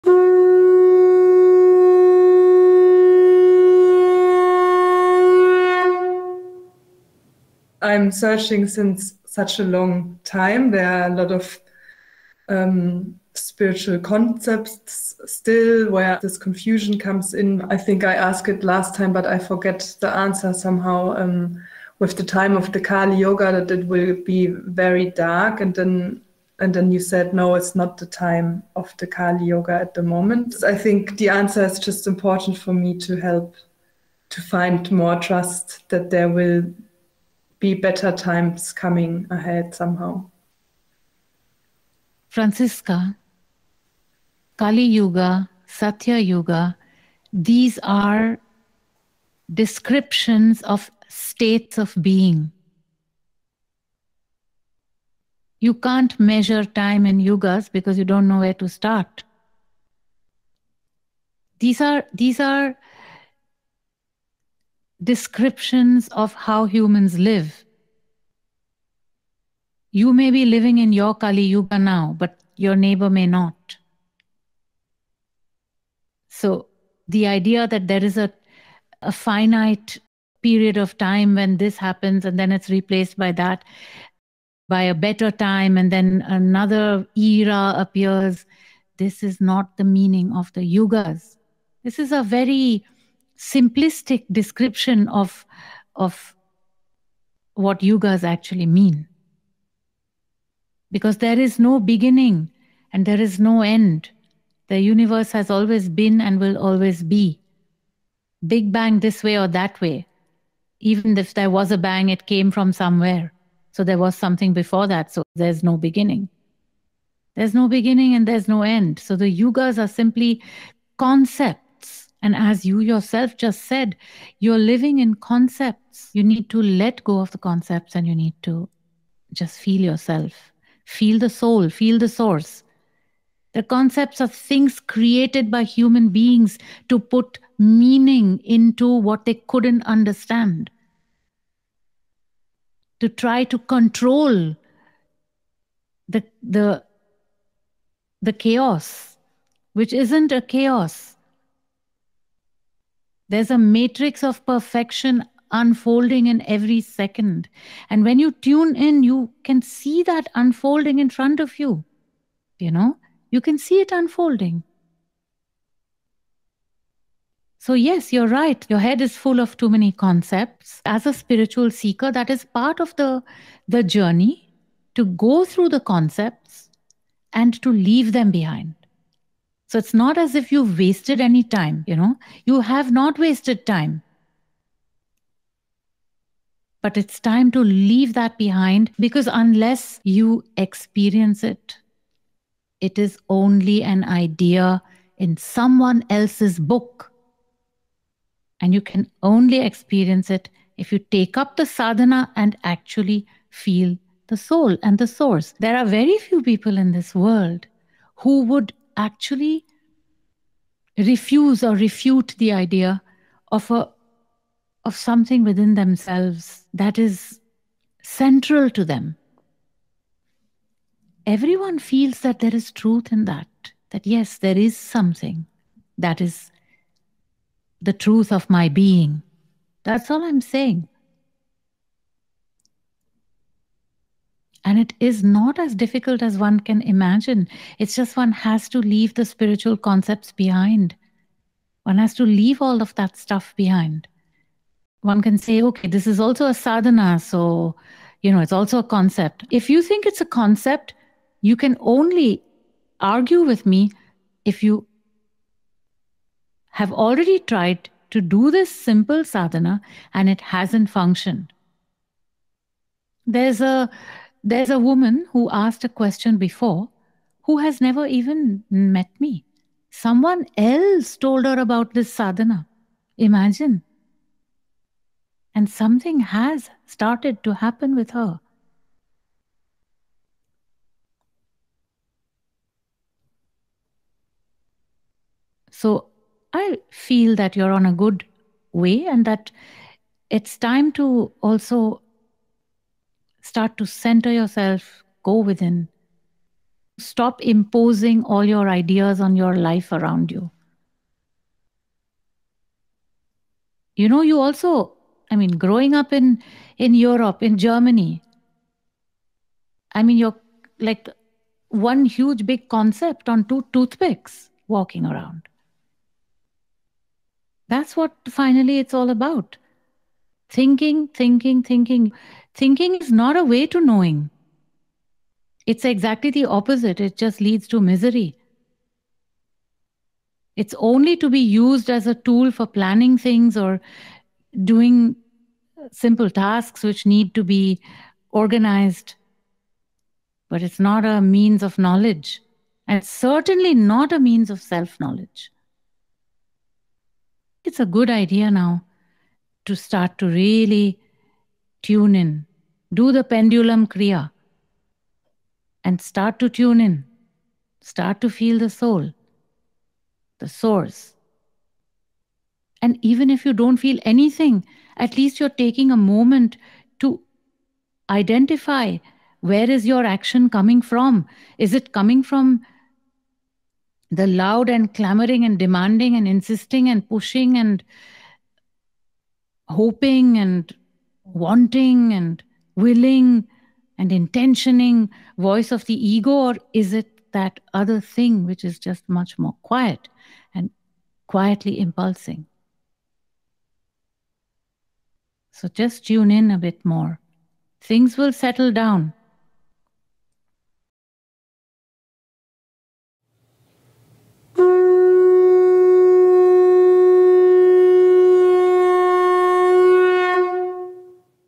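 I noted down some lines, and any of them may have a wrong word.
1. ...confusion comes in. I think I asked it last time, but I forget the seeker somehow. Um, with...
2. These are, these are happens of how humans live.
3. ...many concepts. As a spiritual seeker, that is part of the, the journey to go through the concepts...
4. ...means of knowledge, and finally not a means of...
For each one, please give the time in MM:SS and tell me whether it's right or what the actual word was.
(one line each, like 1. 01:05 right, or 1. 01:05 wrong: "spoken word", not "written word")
1. 00:16 wrong: "answer", not "seeker"
2. 01:01 wrong: "descriptions", not "happens"
3. 02:49 right
4. 05:41 wrong: "certainly", not "finally".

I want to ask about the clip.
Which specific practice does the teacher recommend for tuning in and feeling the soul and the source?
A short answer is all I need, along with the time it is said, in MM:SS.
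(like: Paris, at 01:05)
pendulum kriya, at 05:53.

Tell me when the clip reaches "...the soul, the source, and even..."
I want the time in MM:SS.
05:58.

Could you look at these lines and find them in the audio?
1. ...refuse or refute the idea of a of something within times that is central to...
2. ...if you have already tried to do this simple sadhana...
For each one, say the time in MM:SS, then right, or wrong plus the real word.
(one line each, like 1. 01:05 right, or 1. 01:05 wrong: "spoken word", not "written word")
1. 03:30 wrong: "themselves", not "times"
2. 04:14 right.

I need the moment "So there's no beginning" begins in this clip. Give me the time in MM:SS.
01:55.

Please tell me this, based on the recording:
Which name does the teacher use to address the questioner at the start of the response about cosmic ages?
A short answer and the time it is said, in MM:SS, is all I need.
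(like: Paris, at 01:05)
Franziska, at 00:42.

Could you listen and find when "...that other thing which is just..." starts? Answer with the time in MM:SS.
06:27.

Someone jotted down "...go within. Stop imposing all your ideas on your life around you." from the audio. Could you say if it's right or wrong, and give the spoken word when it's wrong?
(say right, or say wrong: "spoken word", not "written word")
right.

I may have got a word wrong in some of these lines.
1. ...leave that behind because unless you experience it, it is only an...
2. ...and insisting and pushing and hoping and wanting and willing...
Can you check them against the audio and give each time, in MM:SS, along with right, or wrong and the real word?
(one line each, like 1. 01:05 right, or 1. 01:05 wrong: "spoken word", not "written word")
1. 03:07 right
2. 06:16 right.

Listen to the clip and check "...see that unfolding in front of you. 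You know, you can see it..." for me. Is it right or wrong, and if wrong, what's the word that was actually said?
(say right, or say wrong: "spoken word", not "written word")
right.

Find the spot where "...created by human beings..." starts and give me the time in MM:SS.
02:14.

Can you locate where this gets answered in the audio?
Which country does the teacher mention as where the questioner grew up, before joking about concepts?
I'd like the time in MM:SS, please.
05:07.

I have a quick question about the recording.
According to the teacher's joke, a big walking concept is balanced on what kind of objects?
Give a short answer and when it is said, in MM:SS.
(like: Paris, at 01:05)
two toothpicks, at 05:13.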